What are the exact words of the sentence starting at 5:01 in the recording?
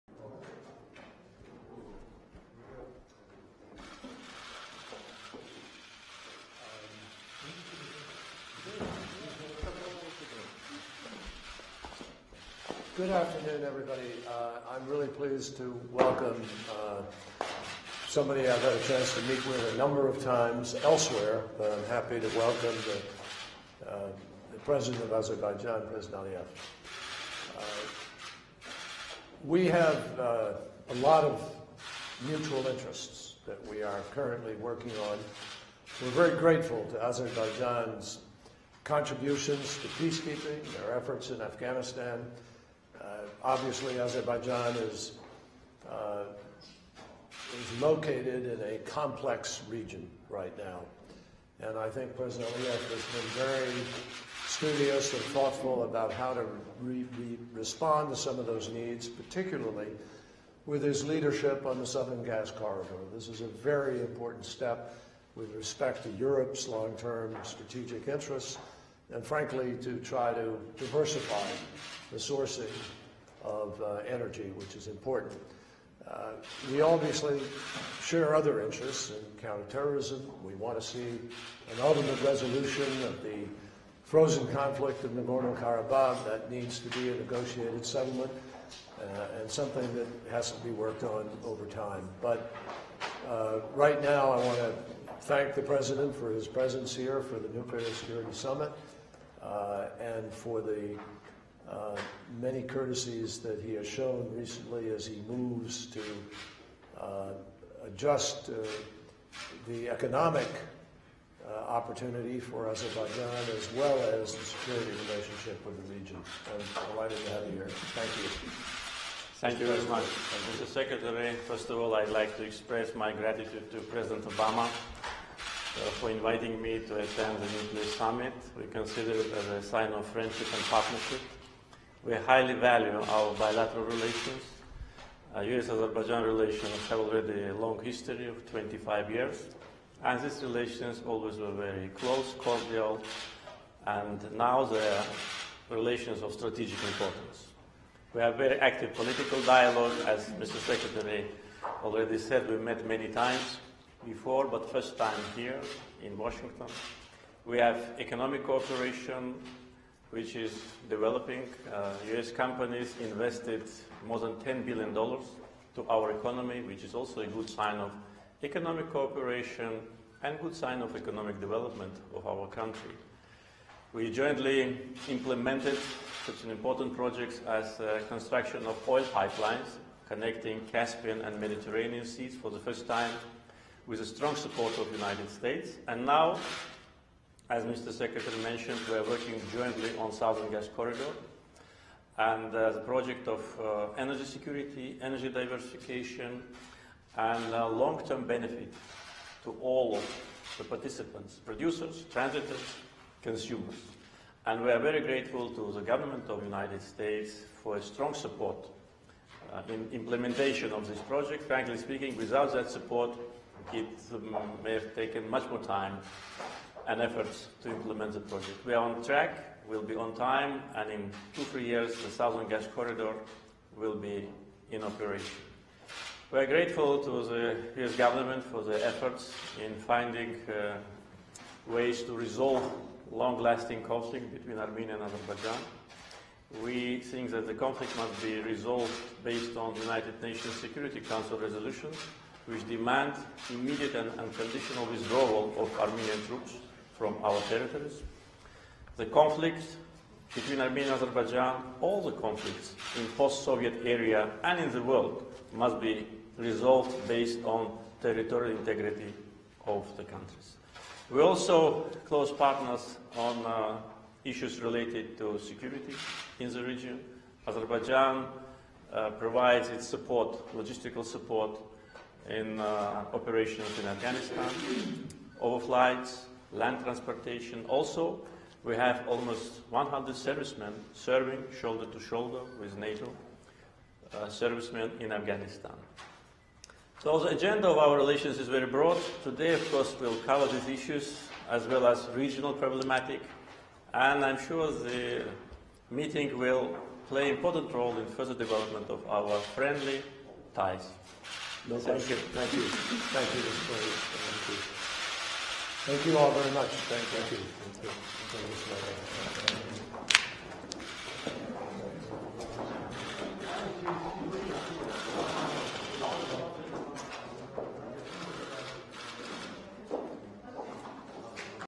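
No, thank you, thank you, thank you, Mr.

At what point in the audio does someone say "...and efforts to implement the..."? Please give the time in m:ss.
3:36.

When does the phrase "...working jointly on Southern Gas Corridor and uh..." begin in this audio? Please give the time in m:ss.
3:09.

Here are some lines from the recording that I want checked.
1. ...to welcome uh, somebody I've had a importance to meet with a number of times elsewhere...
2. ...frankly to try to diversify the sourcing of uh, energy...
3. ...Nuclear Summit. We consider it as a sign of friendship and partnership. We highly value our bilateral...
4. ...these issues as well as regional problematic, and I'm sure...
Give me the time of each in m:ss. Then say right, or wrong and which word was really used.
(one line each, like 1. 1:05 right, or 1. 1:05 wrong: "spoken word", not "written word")
1. 0:15 wrong: "chance", not "importance"
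2. 1:09 right
3. 2:07 right
4. 4:50 right.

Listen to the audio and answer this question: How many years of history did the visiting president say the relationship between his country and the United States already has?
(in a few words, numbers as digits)
25.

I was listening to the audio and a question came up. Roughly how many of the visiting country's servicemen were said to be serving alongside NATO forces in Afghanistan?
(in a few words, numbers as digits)
almost 100.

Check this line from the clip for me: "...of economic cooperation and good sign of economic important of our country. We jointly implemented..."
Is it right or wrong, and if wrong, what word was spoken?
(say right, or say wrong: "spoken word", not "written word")
wrong: "development", not "important".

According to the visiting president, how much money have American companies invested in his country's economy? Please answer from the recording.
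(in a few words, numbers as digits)
more than $10 billion.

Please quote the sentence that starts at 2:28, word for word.
We have very active political dialogue, as Mr.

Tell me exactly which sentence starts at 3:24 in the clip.
And we are very grateful to the government of the United States for a strong support uh, in implementation of this project.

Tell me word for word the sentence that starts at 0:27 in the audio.
Uh, we have uh, a lot of mutual interests that we are currently working on.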